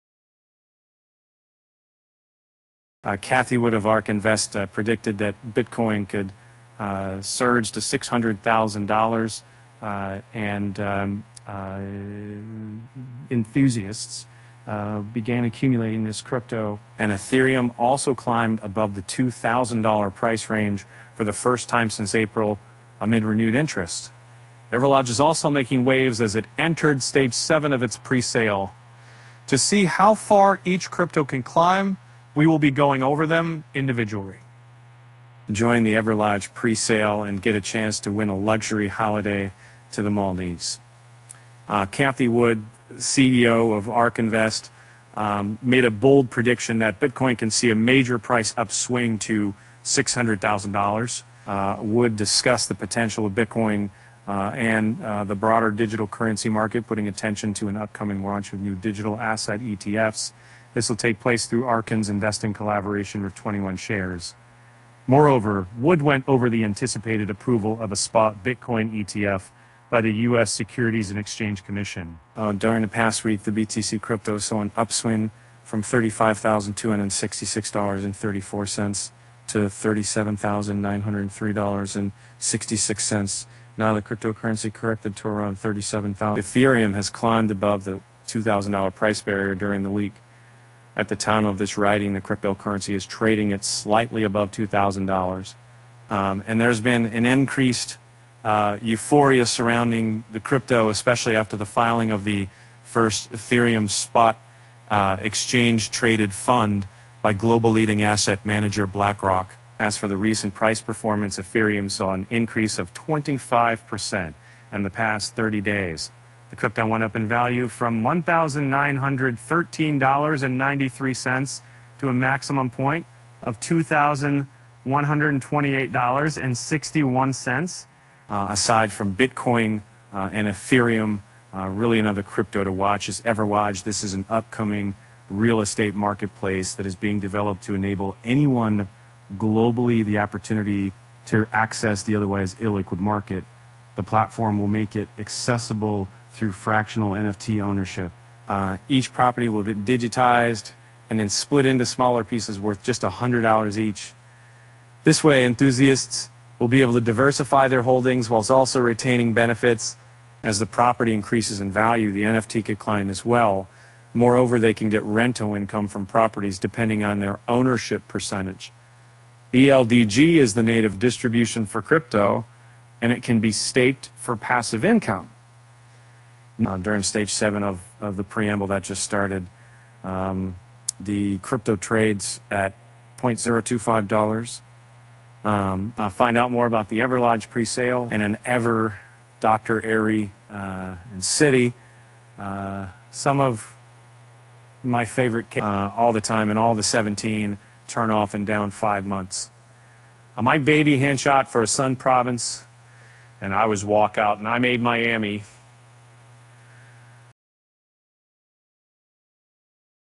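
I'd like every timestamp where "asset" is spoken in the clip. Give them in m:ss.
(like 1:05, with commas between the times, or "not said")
0:59, 1:48.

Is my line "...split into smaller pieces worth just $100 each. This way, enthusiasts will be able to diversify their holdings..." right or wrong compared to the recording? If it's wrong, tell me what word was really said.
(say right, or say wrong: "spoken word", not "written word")
right.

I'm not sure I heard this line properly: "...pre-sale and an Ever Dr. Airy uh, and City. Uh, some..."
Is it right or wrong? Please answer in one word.
right.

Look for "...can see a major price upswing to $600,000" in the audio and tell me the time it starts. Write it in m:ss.
0:47.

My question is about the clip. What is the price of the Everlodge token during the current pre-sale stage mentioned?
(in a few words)
$0.025.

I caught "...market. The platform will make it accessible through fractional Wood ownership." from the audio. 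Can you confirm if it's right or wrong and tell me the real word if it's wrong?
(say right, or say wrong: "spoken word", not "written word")
wrong: "NFT", not "Wood".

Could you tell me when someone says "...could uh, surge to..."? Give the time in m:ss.
0:06.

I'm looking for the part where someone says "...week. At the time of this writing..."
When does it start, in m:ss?
1:29.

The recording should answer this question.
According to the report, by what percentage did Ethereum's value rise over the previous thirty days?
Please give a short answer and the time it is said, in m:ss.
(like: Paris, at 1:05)
25%, at 1:52.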